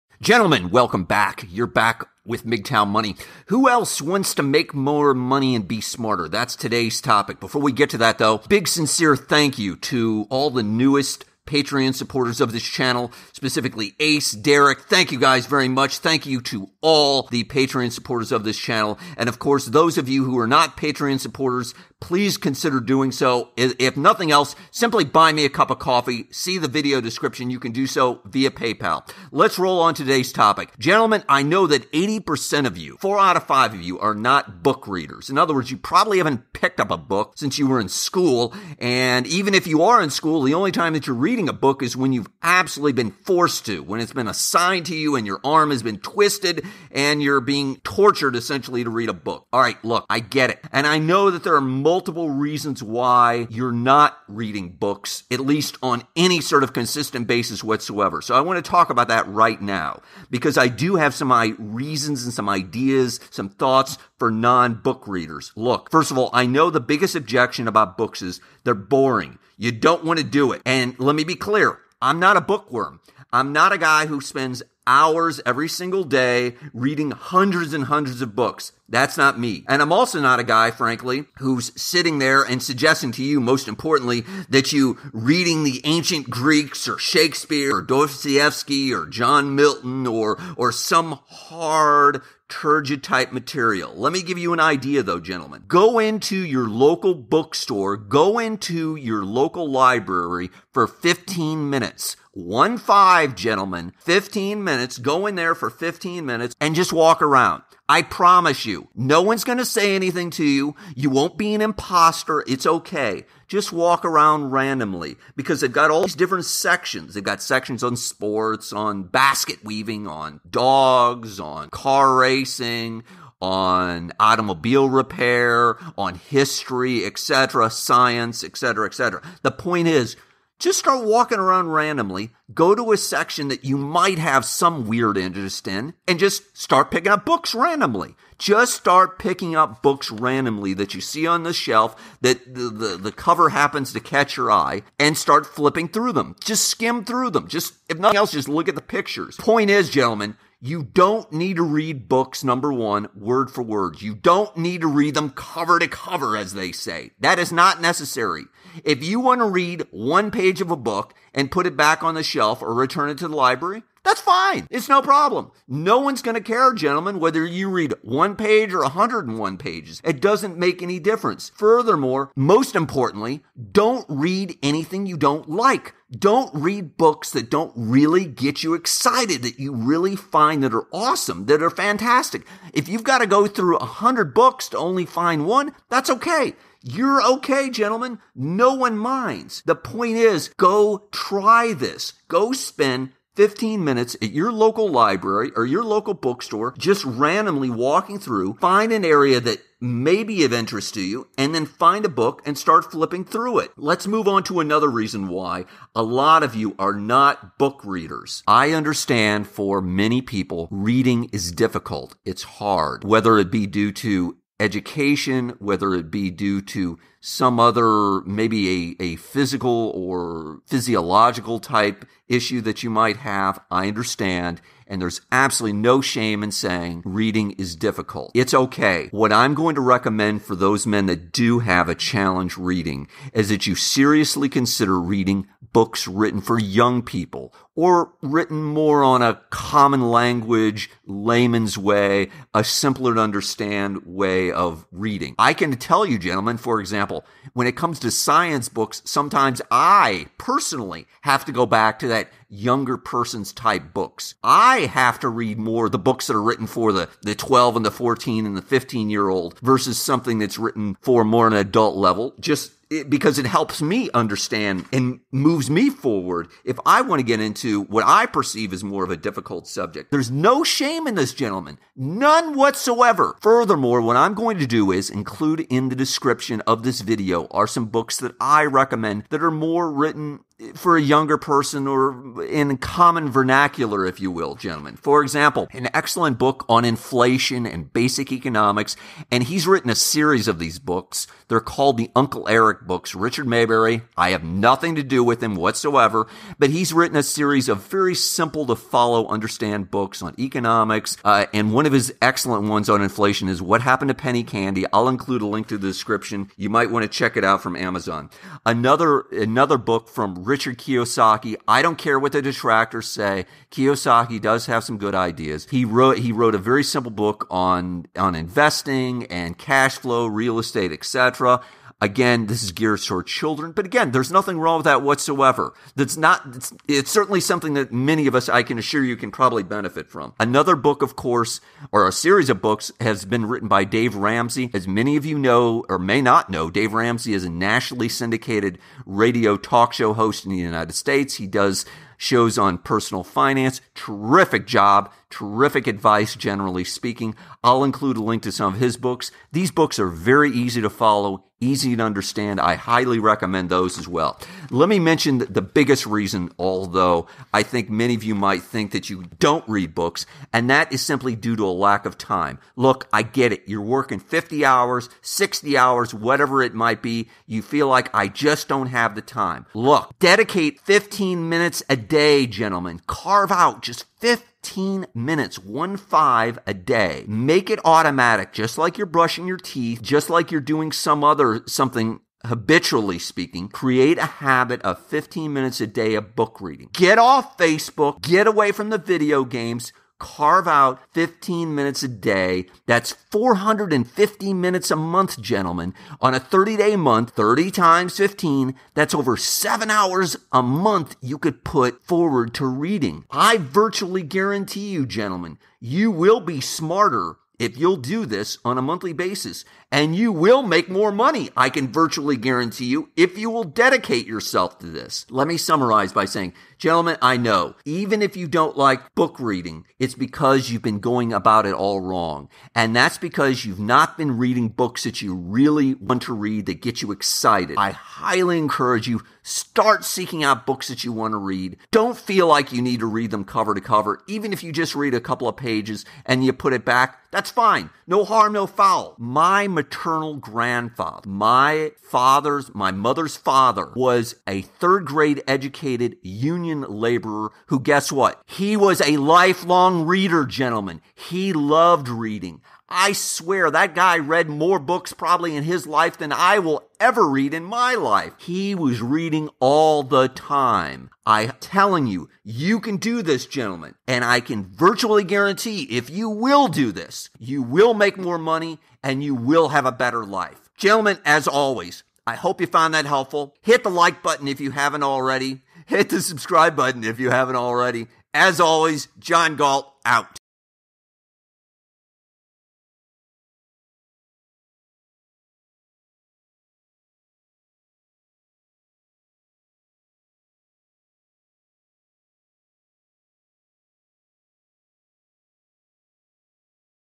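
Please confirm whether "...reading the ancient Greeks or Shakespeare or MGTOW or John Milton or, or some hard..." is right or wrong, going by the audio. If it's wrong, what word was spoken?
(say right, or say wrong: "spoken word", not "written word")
wrong: "Dostoevsky", not "MGTOW".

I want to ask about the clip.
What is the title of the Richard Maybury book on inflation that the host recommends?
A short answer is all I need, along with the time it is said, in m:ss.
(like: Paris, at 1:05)
What Happened to Penny Candy, at 5:03.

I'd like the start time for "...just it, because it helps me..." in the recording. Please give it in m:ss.
4:22.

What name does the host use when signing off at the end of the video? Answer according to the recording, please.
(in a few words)
John Galt.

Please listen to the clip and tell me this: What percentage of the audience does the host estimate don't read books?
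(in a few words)
80%.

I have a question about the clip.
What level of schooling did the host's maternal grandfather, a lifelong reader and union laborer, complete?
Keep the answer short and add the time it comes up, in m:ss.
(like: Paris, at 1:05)
Third grade, at 7:24.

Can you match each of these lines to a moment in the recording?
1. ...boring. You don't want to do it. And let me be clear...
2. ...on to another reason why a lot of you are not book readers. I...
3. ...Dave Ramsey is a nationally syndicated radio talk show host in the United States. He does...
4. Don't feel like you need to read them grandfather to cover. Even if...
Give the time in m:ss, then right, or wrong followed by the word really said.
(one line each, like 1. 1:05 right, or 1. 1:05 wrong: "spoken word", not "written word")
1. 1:08 right
2. 3:24 right
3. 5:36 right
4. 7:11 wrong: "cover", not "grandfather".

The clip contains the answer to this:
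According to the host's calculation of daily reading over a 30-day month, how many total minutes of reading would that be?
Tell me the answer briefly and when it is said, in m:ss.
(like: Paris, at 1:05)
450, at 6:33.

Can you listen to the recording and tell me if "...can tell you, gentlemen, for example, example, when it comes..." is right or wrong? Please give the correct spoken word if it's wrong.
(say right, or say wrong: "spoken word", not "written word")
right.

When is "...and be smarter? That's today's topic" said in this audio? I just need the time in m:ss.
0:05.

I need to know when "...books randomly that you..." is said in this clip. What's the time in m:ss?
2:19.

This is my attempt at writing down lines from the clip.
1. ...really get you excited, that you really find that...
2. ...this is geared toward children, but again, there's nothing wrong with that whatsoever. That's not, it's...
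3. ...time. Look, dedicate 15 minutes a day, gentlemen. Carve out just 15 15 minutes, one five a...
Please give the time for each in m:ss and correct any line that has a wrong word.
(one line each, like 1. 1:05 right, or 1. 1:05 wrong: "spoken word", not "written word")
1. 2:57 right
2. 5:22 right
3. 6:09 right.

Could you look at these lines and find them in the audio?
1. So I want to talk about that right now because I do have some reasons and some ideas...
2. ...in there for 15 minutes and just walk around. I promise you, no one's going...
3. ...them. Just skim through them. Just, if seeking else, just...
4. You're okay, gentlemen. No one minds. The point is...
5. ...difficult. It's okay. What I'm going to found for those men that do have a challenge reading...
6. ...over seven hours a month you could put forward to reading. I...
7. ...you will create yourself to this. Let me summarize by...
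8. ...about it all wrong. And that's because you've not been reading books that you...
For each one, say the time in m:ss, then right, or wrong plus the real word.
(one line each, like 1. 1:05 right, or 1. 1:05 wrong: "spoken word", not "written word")
1. 0:58 right
2. 1:45 right
3. 2:26 wrong: "nothing", not "seeking"
4. 3:06 right
5. 3:47 wrong: "recommend", not "found"
6. 6:39 right
7. 6:53 wrong: "dedicate", not "create"
8. 7:01 right.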